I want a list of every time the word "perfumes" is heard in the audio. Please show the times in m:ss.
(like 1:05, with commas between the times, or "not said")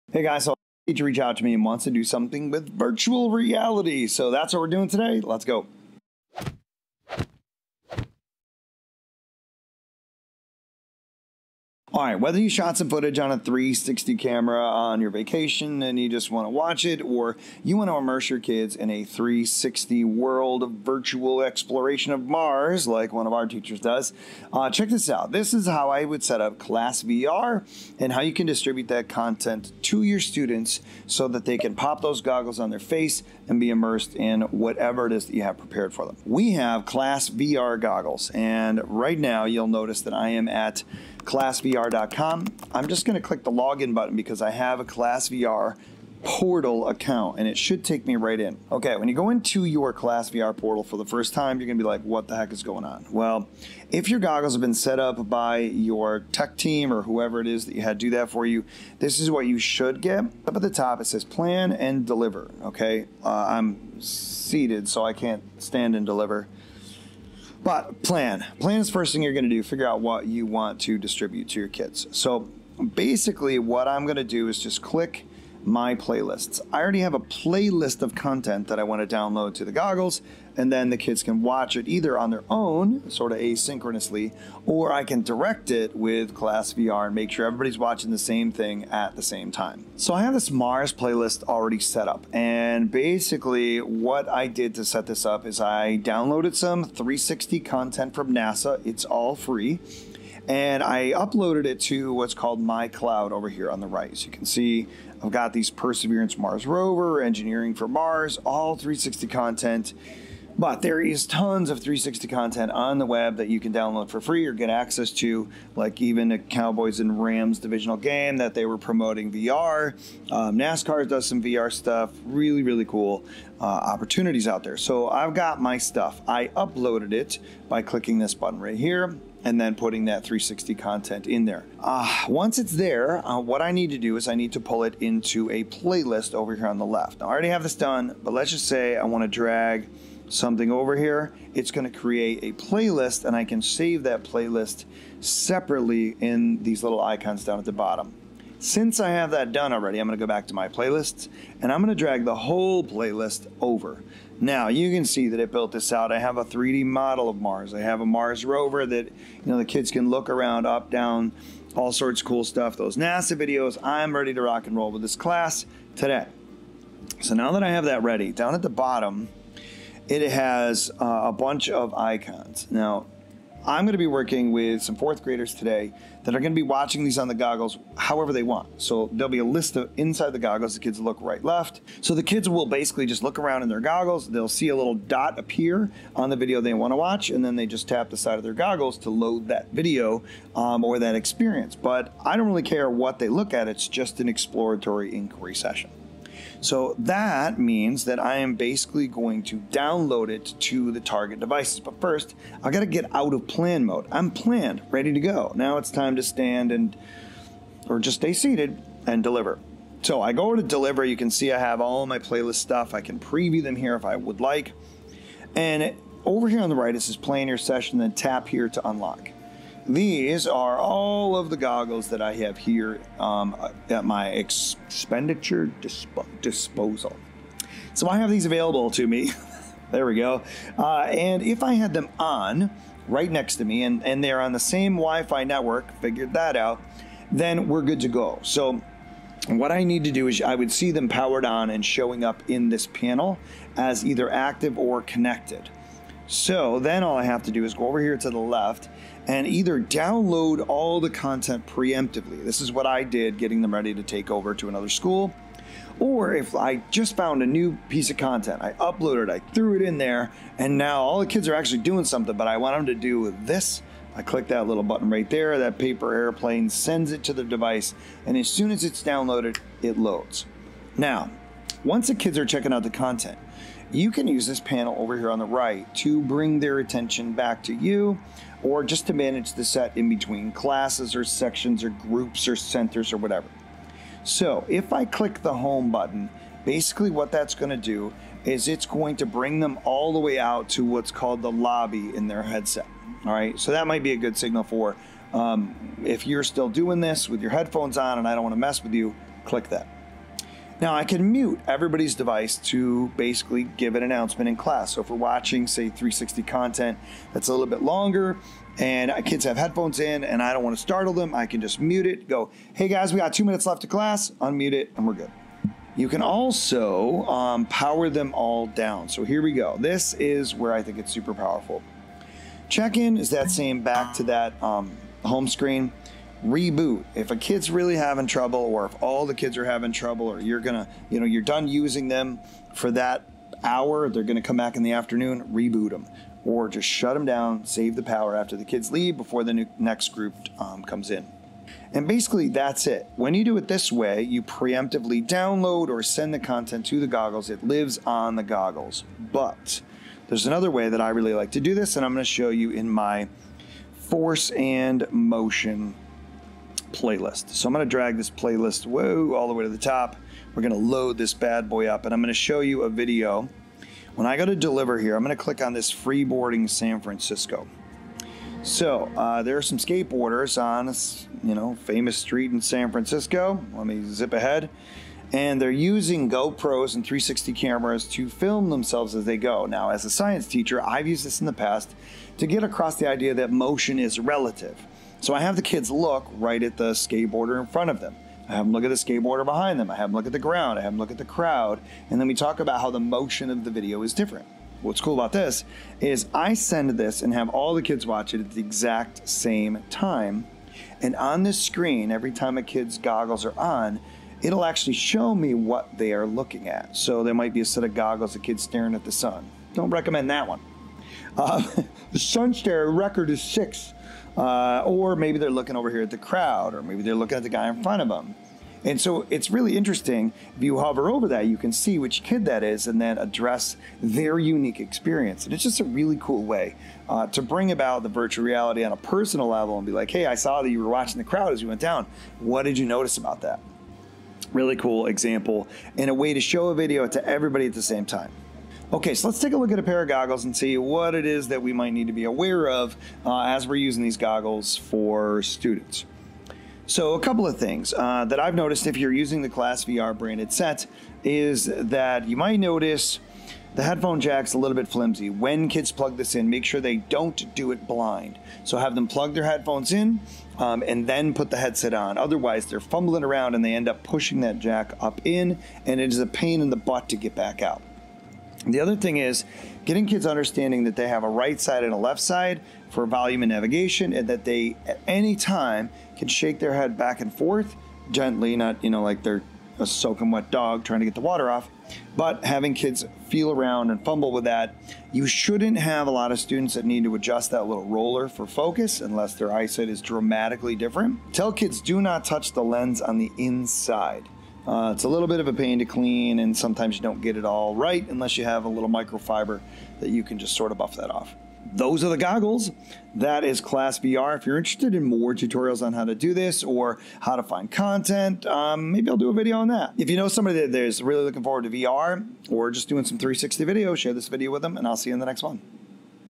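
not said.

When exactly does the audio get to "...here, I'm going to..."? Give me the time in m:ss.
6:04.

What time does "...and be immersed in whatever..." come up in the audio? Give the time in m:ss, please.
0:33.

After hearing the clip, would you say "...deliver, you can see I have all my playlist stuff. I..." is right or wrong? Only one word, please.
right.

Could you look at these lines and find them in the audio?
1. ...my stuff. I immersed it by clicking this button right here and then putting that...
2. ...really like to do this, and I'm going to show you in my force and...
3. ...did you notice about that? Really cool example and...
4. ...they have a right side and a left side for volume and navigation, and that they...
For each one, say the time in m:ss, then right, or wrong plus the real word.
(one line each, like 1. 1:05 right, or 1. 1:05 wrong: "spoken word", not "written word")
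1. 2:05 wrong: "uploaded", not "immersed"
2. 5:51 right
3. 7:12 right
4. 7:50 right.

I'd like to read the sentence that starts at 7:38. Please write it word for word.
So have them plug their headphones in um, and then put the headset on.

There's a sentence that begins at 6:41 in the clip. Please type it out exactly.
And on this screen, every time a kid's goggles are on, it'll actually show me what they are looking at.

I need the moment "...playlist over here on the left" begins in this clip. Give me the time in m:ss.
2:15.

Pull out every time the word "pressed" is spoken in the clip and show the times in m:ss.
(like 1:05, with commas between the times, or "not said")
not said.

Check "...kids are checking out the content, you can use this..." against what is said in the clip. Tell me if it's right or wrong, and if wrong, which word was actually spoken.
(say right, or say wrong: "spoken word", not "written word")
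right.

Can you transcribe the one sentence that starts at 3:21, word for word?
But first, I gotta get out of plan mode.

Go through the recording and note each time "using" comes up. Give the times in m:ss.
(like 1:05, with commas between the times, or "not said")
5:31, 6:15, 7:23, 7:29.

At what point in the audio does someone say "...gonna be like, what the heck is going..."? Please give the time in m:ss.
0:51.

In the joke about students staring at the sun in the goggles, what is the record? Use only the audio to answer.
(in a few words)
6.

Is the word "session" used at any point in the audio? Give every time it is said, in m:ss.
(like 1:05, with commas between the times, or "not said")
3:15, 3:37.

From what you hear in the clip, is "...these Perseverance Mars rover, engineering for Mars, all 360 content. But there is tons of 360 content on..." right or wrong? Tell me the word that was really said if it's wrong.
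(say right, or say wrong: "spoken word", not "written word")
right.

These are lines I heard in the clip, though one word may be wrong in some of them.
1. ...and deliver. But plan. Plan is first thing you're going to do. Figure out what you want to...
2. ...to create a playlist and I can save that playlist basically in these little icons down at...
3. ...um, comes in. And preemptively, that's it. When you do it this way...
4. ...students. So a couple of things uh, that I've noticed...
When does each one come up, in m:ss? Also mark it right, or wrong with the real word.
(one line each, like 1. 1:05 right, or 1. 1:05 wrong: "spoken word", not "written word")
1. 1:05 right
2. 2:21 wrong: "separately", not "basically"
3. 5:40 wrong: "basically", not "preemptively"
4. 7:25 right.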